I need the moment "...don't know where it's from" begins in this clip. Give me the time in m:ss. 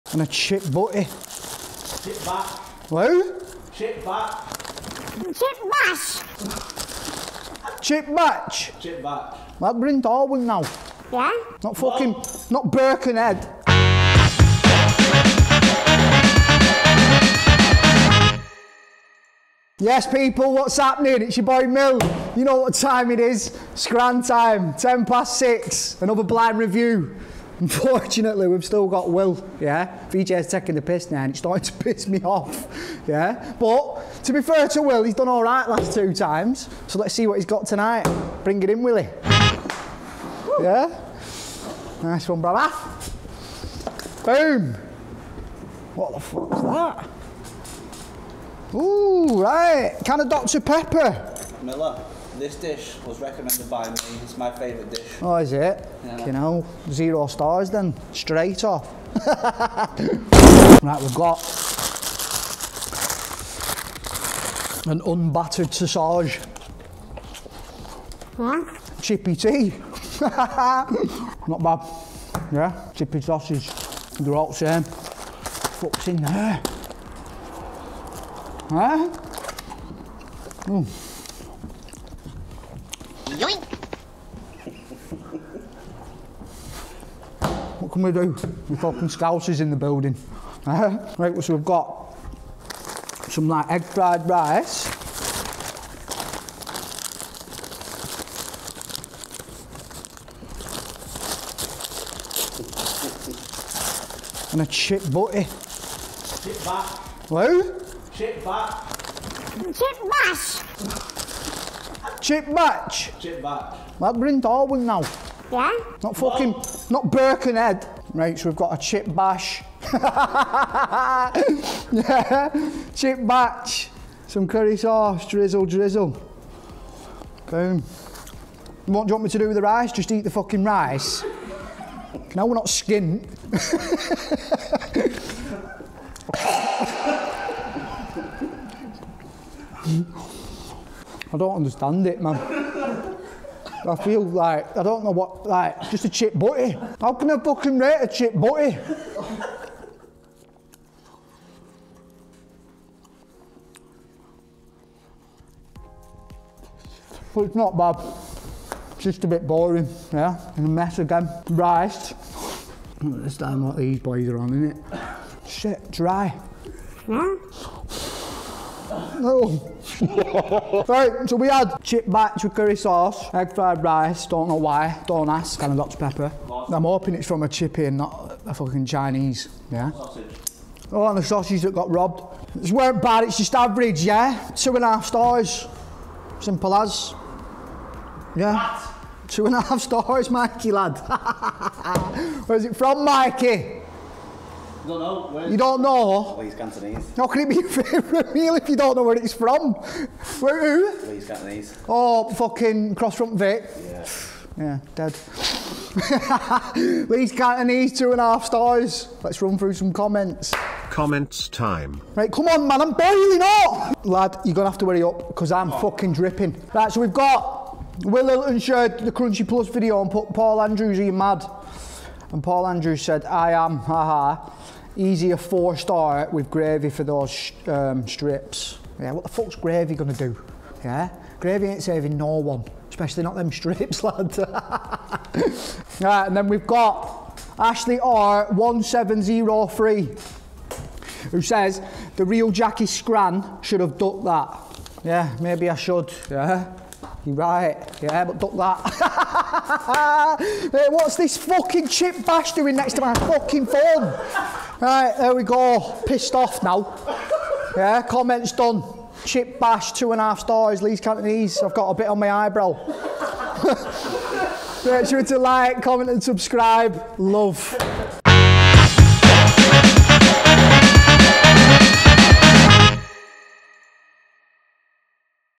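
3:18.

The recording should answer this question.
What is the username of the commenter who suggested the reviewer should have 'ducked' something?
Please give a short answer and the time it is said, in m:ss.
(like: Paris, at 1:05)
Ashley R1703, at 3:57.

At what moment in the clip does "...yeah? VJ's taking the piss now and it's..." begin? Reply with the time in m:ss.
0:29.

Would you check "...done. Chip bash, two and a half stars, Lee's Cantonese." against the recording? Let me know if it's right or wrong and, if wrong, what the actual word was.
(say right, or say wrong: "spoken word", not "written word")
right.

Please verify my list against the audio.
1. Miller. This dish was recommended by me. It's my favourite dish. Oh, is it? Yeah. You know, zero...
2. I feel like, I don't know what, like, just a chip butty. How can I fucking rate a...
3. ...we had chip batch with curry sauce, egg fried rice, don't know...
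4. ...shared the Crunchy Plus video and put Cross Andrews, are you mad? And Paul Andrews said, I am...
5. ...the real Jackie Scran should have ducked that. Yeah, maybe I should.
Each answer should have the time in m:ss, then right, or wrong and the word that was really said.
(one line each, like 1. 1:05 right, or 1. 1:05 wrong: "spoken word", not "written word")
1. 0:51 right
2. 2:23 right
3. 2:51 right
4. 3:38 wrong: "Paul", not "Cross"
5. 4:02 right.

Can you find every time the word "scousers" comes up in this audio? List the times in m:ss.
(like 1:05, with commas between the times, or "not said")
1:29.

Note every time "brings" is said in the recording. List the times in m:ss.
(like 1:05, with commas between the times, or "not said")
0:09, 0:38, 1:54.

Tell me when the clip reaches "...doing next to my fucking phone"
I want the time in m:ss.
4:12.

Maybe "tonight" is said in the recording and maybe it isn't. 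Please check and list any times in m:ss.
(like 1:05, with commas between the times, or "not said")
0:37.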